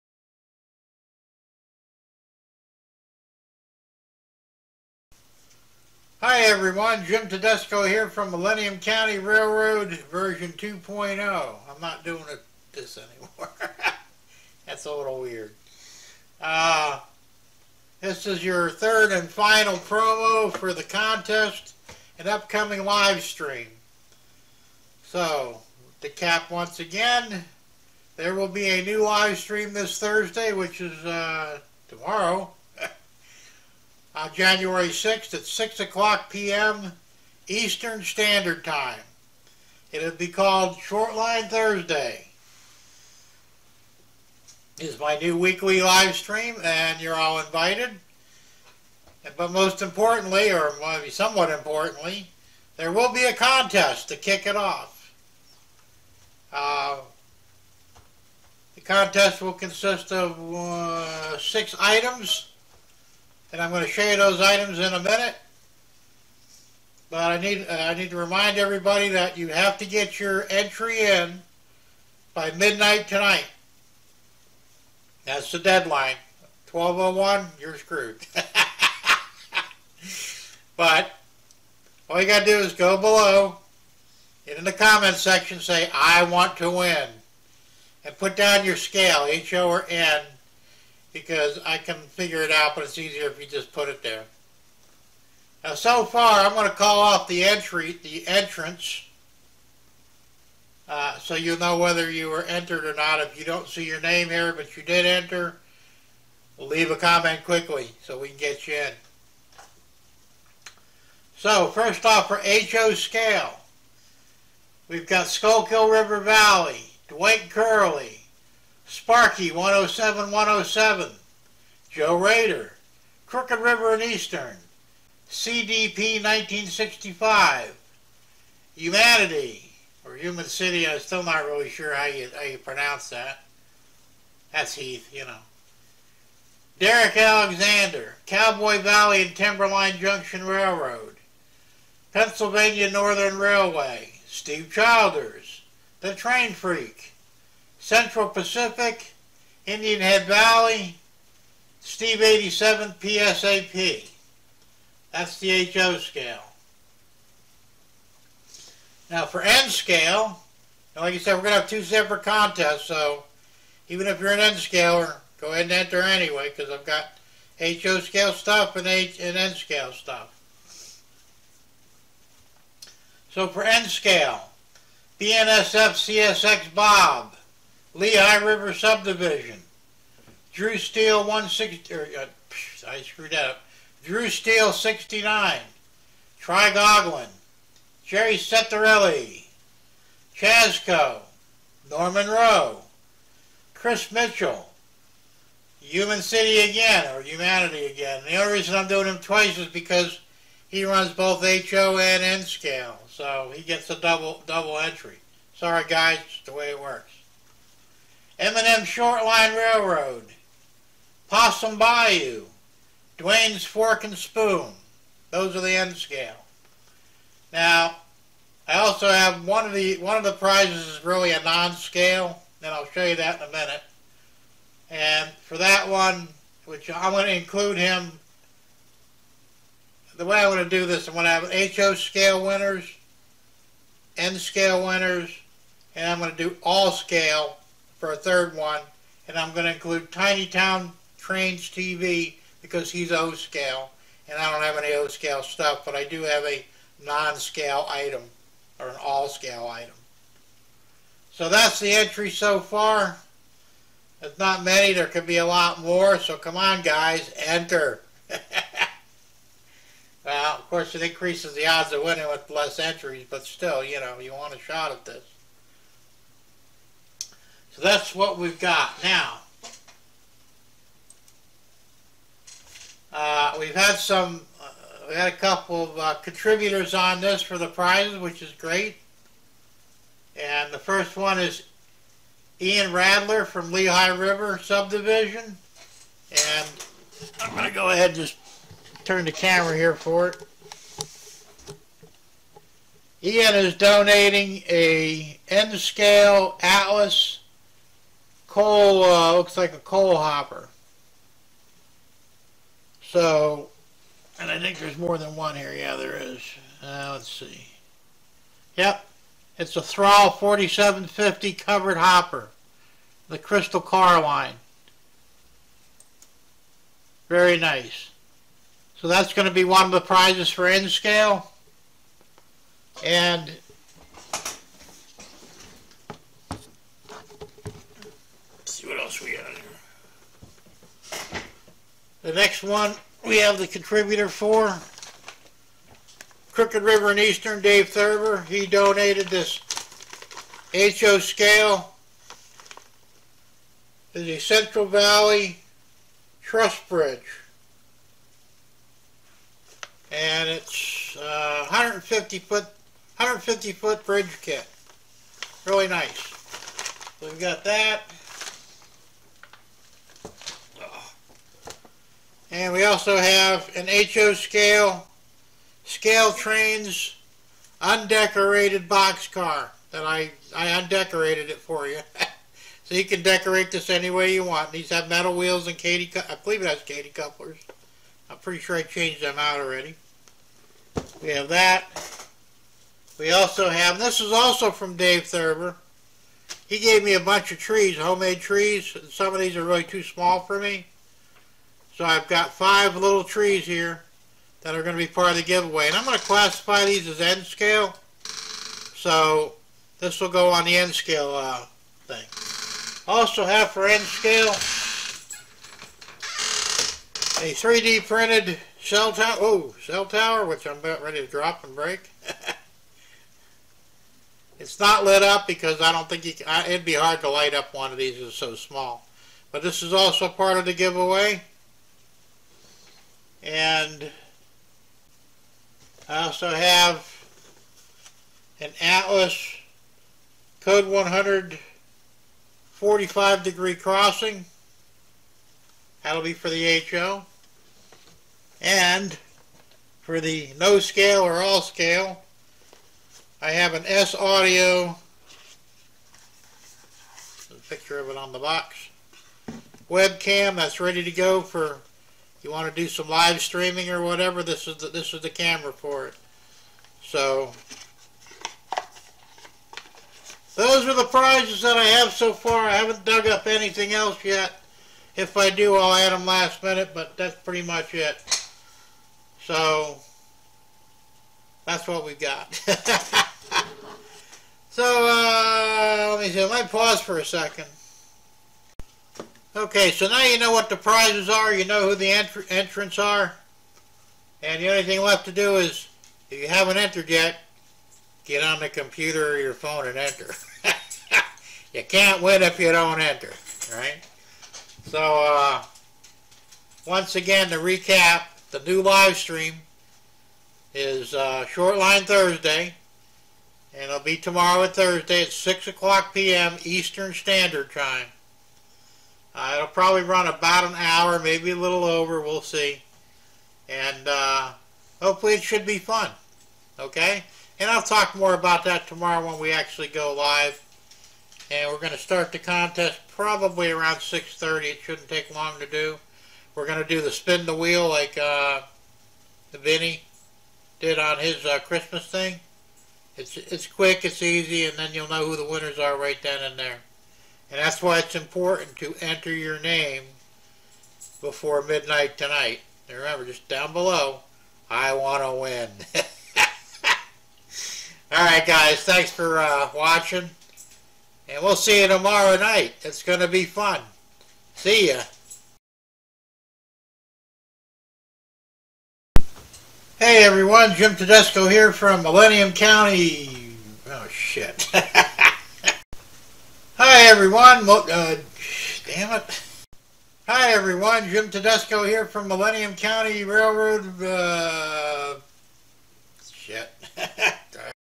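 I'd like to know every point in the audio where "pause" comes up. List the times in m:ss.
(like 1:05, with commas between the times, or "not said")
7:56.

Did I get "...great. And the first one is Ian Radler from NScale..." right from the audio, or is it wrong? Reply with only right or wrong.
wrong.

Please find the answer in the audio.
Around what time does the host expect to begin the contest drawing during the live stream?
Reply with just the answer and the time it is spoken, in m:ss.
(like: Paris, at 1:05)
6:30, at 8:43.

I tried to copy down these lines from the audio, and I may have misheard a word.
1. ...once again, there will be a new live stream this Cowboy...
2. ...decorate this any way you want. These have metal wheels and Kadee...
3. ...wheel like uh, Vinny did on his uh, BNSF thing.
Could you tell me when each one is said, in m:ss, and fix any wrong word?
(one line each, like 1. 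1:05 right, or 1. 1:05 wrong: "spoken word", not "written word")
1. 0:26 wrong: "Thursday", not "Cowboy"
2. 6:13 right
3. 8:47 wrong: "Christmas", not "BNSF".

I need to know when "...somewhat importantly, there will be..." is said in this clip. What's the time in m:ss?
0:51.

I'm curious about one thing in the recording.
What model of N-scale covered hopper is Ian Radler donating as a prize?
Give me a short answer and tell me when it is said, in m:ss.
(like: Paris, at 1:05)
Thrall 4750, at 5:09.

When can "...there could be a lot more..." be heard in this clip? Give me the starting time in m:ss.
4:14.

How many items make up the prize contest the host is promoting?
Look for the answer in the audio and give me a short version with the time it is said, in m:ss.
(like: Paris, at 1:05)
6, at 1:01.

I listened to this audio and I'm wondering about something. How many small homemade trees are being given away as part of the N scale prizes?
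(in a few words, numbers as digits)
5.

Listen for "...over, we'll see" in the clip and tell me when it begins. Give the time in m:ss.
8:31.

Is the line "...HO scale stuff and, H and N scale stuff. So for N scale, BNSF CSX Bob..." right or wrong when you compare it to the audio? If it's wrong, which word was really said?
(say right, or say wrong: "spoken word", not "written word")
right.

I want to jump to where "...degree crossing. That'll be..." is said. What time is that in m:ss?
7:13.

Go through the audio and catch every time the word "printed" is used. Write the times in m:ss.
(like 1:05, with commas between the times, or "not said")
6:48.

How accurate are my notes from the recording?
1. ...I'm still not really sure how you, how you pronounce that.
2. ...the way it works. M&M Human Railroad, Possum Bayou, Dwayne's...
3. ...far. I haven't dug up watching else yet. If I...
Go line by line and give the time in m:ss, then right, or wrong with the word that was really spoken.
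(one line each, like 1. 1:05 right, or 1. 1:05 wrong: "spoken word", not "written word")
1. 2:10 right
2. 3:26 wrong: "Shortline", not "Human"
3. 7:42 wrong: "anything", not "watching".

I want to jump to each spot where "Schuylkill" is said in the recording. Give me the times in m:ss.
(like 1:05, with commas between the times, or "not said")
1:55.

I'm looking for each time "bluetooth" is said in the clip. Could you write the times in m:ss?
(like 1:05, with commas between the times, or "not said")
not said.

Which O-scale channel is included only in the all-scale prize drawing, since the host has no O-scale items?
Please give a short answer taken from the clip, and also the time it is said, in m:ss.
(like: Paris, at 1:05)
Tiny Town Trains TV, at 4:00.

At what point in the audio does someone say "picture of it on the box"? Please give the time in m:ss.
7:27.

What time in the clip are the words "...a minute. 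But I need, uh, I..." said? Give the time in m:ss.
1:04.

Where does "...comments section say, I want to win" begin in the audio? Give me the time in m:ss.
1:24.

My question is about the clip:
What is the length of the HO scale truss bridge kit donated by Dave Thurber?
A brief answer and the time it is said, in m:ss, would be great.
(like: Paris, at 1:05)
150 feet, at 5:53.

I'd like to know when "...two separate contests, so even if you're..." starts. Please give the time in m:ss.
2:41.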